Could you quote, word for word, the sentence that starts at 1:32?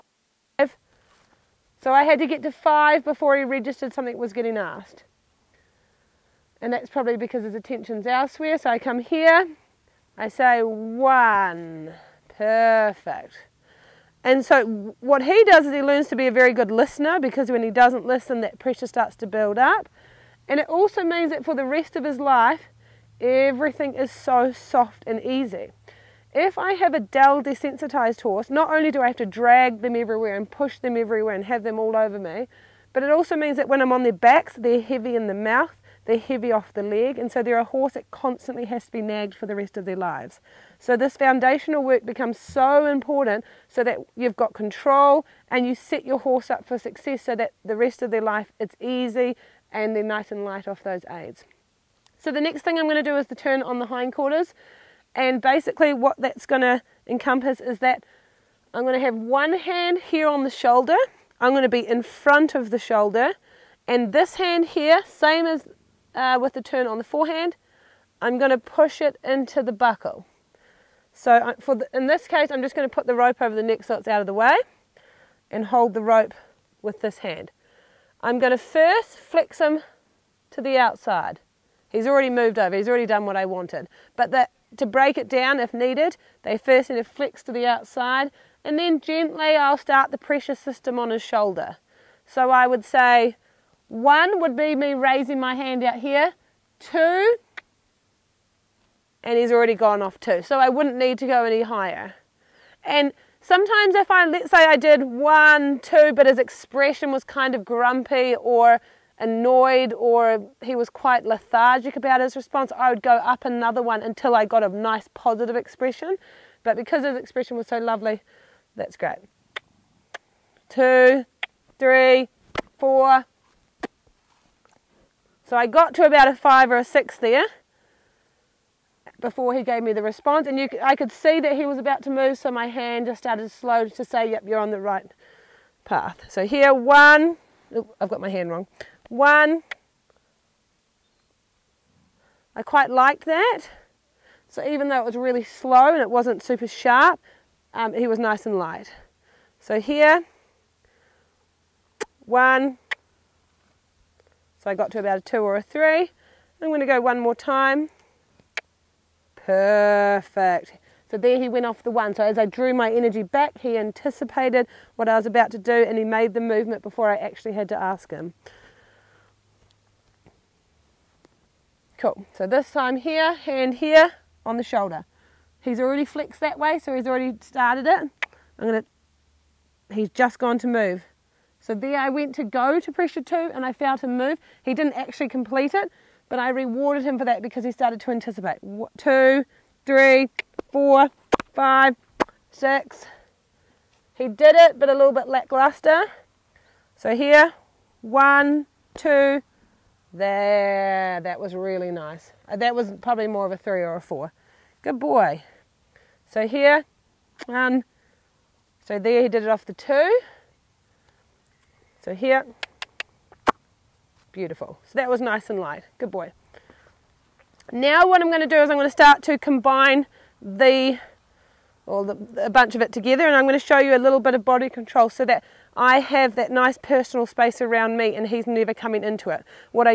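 So I would say one would be me raising my hand out here.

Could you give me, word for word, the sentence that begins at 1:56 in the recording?
But because his expression was so lovely, that's great.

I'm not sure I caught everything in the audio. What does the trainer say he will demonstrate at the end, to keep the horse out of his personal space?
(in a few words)
body control.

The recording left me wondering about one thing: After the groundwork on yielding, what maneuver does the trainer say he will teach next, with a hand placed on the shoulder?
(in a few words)
turn on the hindquarters.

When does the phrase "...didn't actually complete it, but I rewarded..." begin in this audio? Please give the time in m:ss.
3:04.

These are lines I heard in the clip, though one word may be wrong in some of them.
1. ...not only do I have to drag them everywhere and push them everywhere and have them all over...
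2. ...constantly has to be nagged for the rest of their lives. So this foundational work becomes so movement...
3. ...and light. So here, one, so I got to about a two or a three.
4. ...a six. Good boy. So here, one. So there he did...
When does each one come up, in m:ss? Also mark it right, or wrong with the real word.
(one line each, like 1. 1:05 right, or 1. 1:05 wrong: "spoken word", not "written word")
1. 0:28 right
2. 0:38 wrong: "important", not "movement"
3. 2:28 right
4. 3:23 wrong: "four", not "six".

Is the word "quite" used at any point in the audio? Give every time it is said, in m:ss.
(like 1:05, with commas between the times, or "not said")
1:50, 2:22.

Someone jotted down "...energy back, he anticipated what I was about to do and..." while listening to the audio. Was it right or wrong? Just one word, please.
right.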